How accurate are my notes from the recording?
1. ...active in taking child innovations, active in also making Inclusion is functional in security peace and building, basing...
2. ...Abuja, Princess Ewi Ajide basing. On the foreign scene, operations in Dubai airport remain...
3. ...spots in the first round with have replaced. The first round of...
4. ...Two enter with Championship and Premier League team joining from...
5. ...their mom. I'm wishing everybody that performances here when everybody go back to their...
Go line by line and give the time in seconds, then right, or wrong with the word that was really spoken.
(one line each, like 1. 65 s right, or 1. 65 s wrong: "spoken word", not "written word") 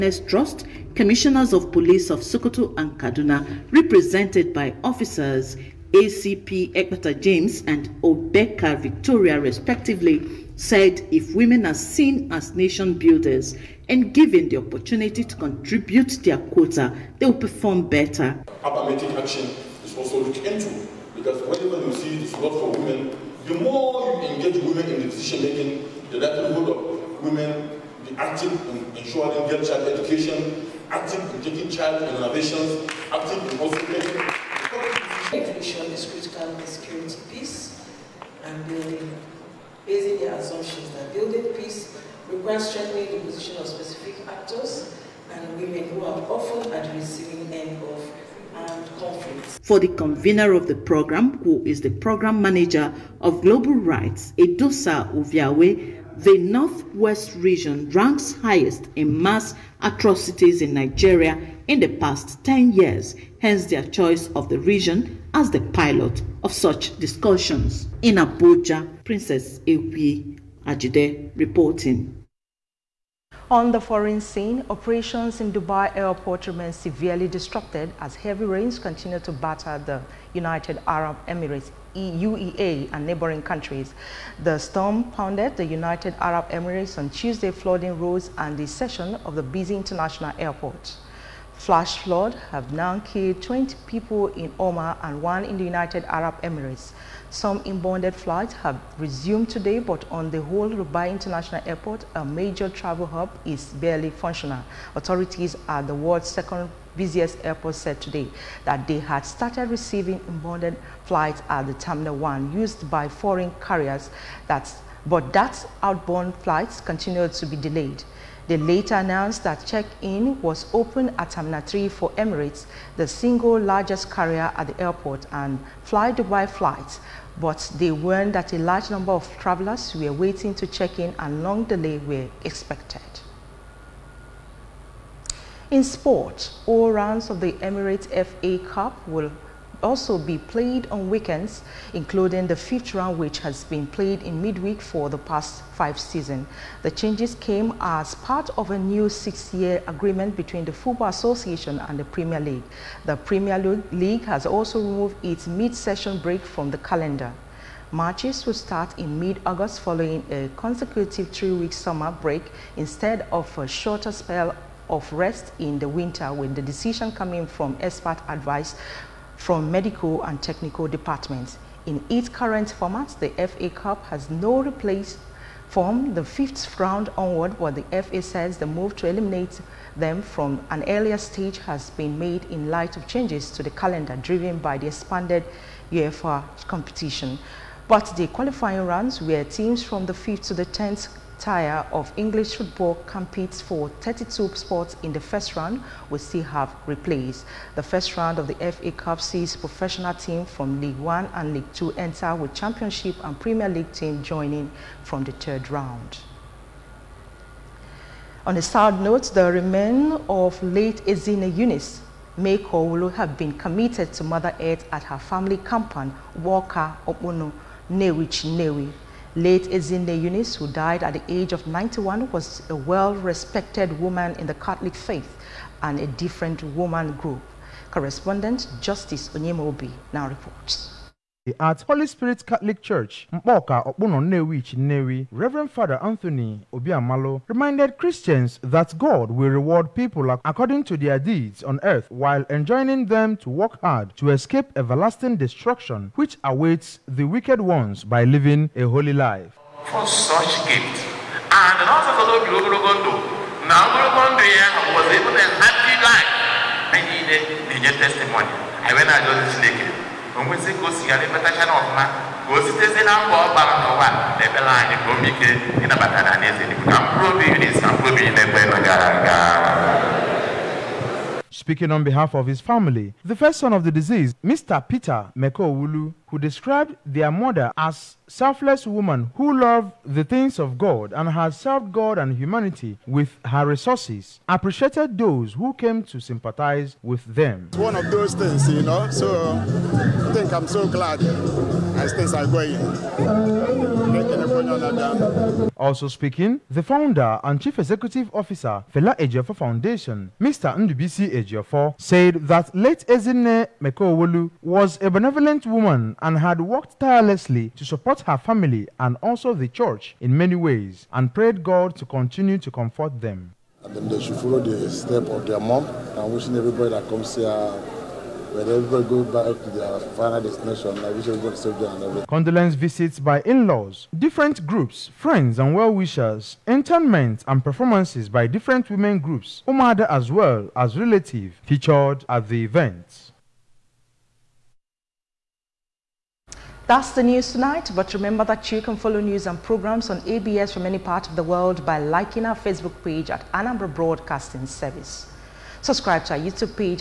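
1. 30 s wrong: "critical", not "functional"
2. 68 s wrong: "reporting", not "basing"
3. 194 s right
4. 201 s right
5. 315 s wrong: "comes", not "performances".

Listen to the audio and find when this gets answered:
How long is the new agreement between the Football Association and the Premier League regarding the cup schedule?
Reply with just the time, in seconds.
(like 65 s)
149 s.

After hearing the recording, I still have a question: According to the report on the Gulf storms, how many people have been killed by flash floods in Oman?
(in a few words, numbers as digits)
20.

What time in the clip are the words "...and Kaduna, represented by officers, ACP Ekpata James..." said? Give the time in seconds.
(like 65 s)
2 s.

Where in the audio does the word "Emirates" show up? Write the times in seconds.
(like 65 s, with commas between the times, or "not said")
81 s, 86 s, 96 s, 122 s, 137 s.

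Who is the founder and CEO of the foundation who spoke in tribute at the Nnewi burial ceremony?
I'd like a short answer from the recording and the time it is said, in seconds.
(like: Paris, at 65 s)
Ndubisi Ejiofor, at 300 s.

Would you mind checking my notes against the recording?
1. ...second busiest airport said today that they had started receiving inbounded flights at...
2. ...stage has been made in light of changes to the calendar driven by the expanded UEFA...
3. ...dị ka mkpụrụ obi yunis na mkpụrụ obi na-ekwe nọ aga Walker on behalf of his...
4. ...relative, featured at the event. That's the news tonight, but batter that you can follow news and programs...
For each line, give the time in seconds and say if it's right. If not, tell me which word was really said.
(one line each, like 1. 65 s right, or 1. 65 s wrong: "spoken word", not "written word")
1. 106 s right
2. 181 s right
3. 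266 s wrong: "Speaking", not "Walker"
4. 330 s wrong: "remember", not "batter".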